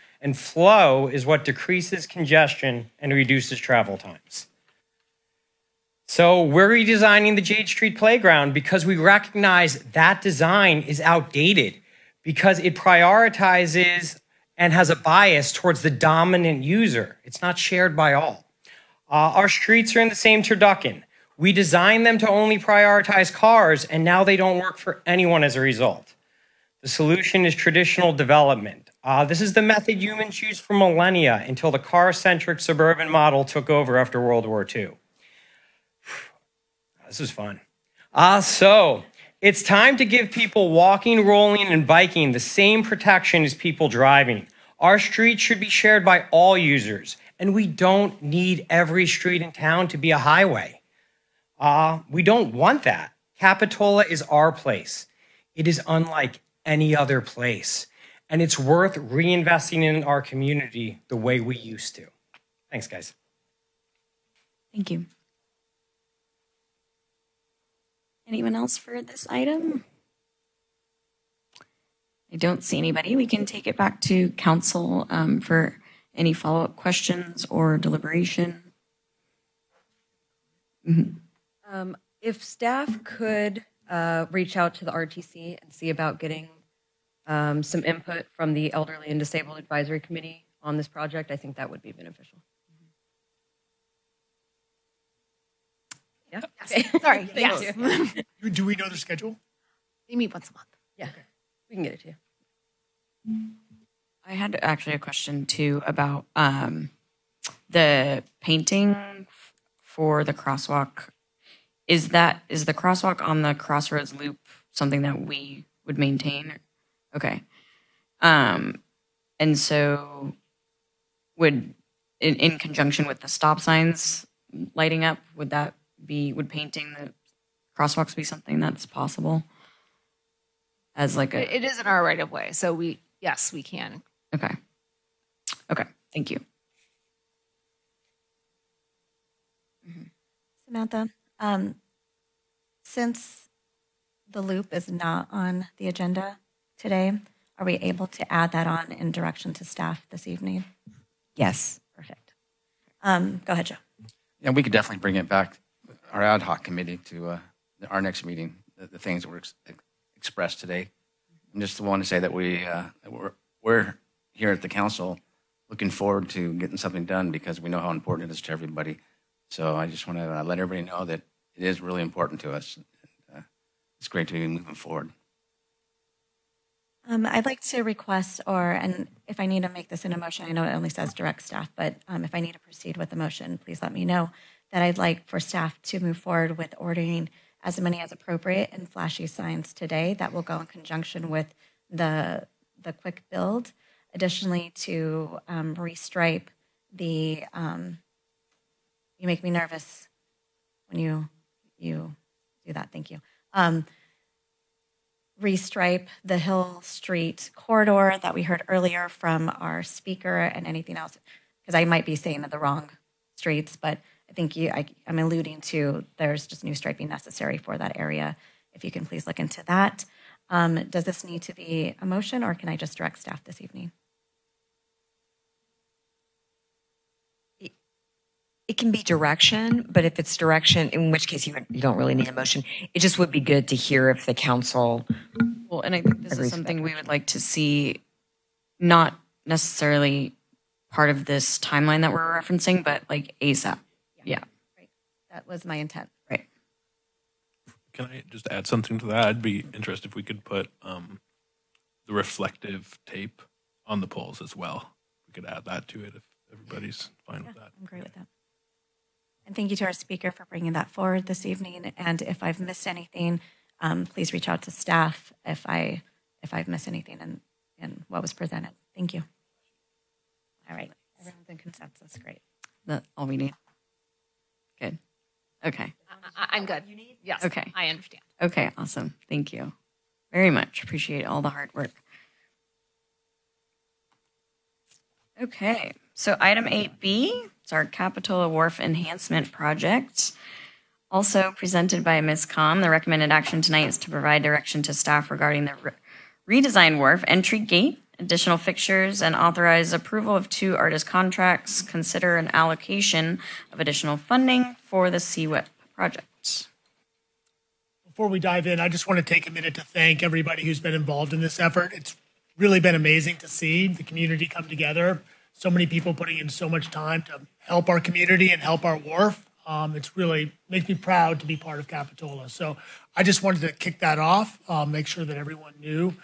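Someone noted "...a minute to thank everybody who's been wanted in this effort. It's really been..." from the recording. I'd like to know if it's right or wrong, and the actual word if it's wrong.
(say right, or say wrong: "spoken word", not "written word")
wrong: "involved", not "wanted".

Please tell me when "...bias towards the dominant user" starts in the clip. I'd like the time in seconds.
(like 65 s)
14 s.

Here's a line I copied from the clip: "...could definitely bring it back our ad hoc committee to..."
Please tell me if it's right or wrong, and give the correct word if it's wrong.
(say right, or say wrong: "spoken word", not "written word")
right.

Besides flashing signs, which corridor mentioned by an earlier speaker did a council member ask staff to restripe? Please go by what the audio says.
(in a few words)
Hill Street corridor.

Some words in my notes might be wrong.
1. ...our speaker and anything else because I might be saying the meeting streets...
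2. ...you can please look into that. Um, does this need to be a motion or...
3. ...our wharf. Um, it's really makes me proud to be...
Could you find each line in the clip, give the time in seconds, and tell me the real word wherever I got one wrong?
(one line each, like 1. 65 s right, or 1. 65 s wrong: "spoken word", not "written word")
1. 209 s wrong: "wrong", not "meeting"
2. 218 s right
3. 318 s right.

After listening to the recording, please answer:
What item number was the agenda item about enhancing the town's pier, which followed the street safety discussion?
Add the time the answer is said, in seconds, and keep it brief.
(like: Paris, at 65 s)
8B, at 286 s.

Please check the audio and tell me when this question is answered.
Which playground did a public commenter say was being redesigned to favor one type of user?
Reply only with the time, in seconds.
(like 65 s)
7 s.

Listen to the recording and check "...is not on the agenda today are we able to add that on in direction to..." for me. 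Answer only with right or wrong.
right.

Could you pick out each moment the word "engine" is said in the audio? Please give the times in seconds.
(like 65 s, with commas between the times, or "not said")
not said.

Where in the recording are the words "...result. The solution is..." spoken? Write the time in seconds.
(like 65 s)
25 s.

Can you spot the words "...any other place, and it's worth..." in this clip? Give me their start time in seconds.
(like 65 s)
56 s.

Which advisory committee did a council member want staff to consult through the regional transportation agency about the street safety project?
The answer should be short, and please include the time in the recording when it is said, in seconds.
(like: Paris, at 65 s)
Elderly and Disabled Advisory Committee, at 88 s.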